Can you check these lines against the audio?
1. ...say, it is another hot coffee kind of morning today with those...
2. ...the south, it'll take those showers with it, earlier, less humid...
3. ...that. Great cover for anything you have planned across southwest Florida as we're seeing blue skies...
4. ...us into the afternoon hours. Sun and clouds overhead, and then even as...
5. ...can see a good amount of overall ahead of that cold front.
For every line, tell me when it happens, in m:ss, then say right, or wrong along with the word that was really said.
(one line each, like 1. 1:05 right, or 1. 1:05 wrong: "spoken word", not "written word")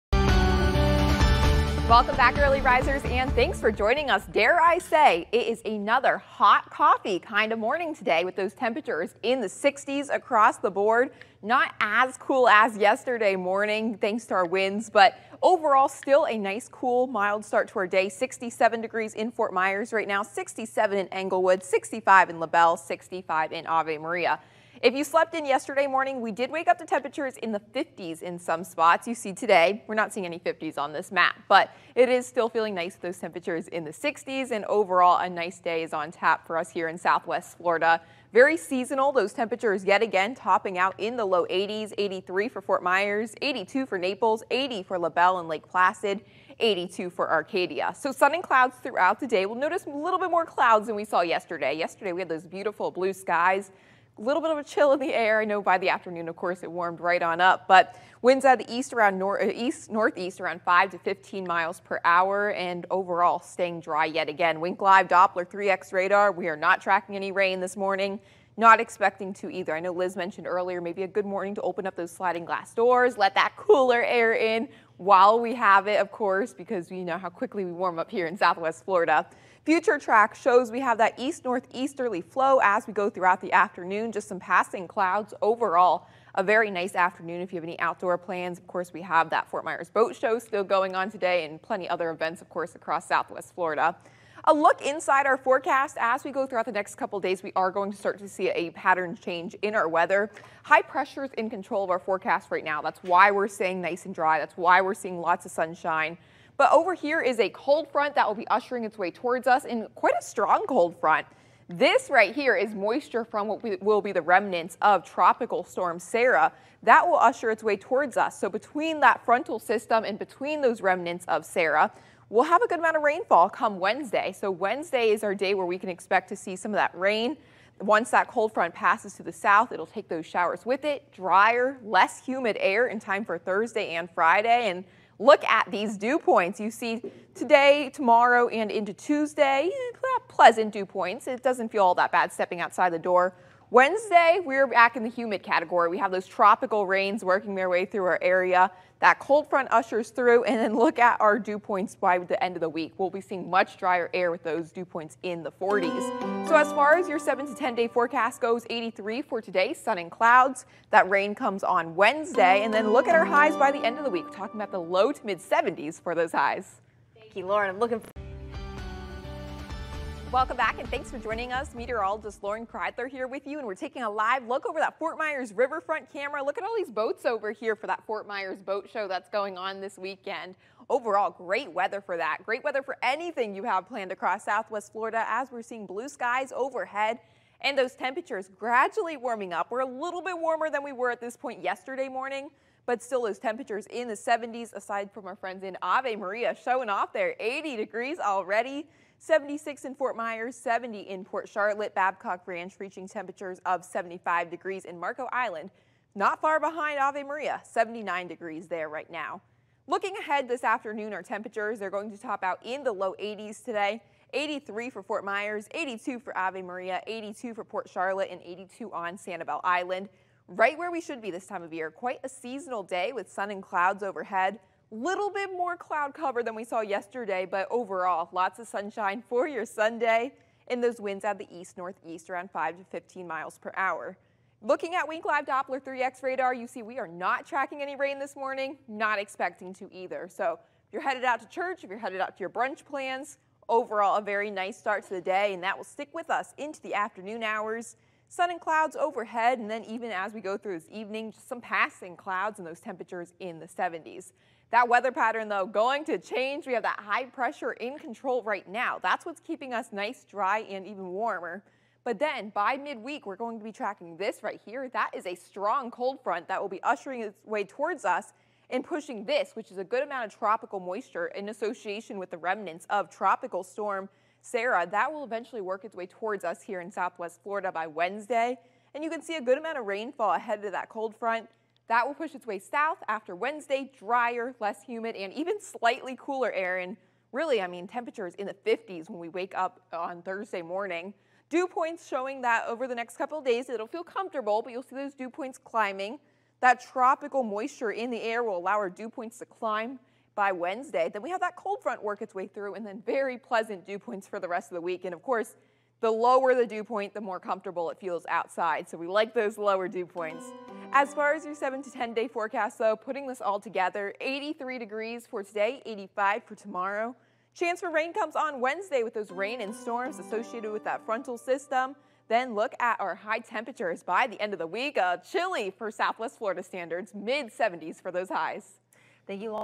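1. 0:04 right
2. 2:09 wrong: "drier", not "earlier"
3. 3:02 wrong: "weather", not "cover"
4. 4:06 right
5. 4:39 wrong: "rainfall", not "overall".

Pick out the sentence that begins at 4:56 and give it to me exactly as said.
That tropical moisture in the air will allow our dew points to climb by Wednesday.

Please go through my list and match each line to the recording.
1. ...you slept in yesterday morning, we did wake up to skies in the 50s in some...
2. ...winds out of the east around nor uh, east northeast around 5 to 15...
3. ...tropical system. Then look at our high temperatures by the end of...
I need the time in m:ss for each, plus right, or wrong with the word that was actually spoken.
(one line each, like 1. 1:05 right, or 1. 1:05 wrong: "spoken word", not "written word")
1. 0:24 wrong: "temperatures", not "skies"
2. 0:58 right
3. 5:21 wrong: "frontal", not "tropical".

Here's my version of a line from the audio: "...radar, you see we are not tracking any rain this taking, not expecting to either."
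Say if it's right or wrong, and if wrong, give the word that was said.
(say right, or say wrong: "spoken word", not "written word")
wrong: "morning", not "taking".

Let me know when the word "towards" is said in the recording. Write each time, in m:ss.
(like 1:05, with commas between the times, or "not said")
1:49, 1:57, 4:27, 4:36.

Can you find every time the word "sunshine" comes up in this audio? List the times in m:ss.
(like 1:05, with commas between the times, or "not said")
1:45, 3:48.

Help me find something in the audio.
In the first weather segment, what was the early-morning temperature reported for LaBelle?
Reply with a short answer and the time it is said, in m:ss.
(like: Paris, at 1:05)
65, at 0:21.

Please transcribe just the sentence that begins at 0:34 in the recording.
And overall, a nice day is on tap for us here in southwest Florida.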